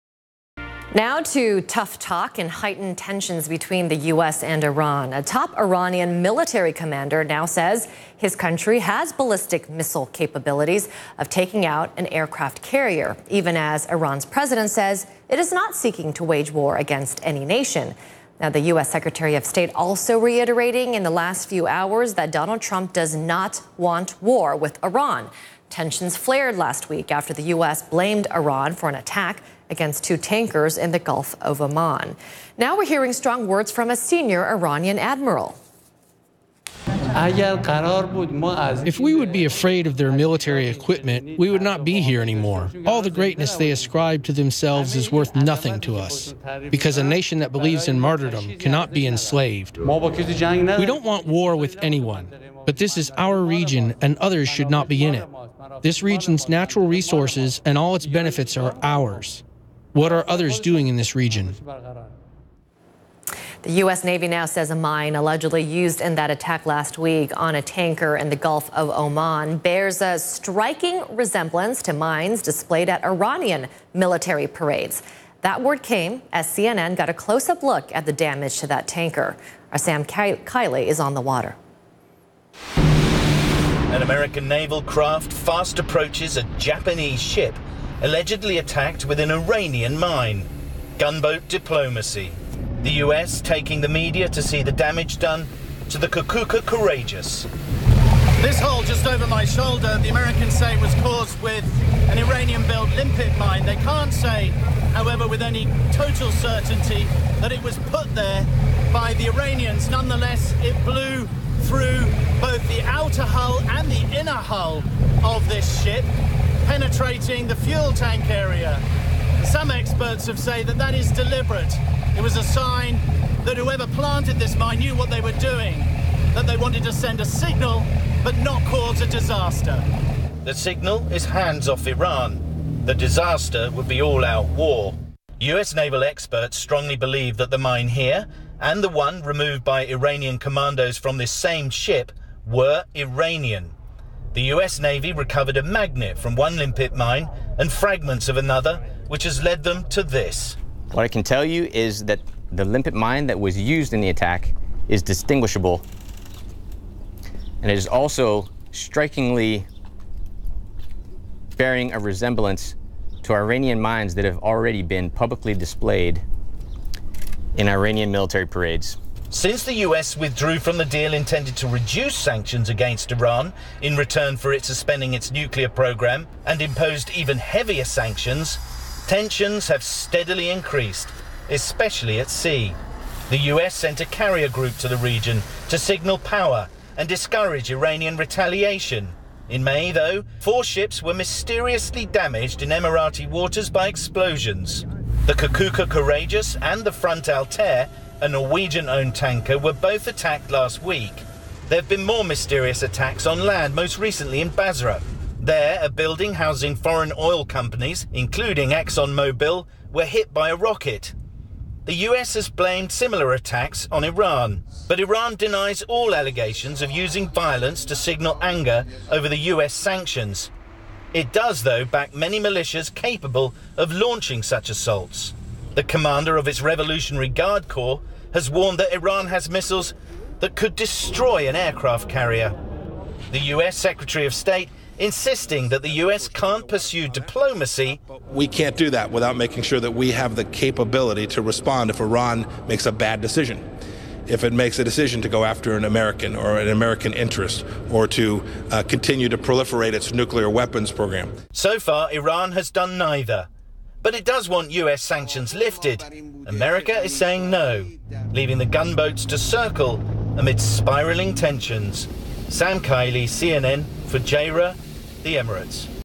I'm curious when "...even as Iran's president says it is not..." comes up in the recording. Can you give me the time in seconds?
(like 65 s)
13 s.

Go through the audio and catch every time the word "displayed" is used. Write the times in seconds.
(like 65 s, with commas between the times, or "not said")
72 s, 165 s.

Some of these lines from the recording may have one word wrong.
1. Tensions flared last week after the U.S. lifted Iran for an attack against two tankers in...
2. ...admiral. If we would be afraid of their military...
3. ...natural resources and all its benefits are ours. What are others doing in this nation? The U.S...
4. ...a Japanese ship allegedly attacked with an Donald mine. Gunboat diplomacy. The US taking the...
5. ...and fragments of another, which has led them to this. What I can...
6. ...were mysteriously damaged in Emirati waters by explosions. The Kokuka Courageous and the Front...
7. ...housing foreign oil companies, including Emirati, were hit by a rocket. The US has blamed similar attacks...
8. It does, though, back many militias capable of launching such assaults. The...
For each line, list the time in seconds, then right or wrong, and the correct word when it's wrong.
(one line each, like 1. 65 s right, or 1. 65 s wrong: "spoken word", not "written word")
1. 25 s wrong: "blamed", not "lifted"
2. 34 s right
3. 56 s wrong: "region", not "nation"
4. 86 s wrong: "Iranian", not "Donald"
5. 147 s right
6. 191 s right
7. 206 s wrong: "ExxonMobil", not "Emirati"
8. 221 s right.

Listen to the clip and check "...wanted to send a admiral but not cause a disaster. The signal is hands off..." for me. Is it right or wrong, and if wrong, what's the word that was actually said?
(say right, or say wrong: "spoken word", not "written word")
wrong: "signal", not "admiral".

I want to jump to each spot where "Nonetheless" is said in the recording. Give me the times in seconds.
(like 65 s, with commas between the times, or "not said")
109 s.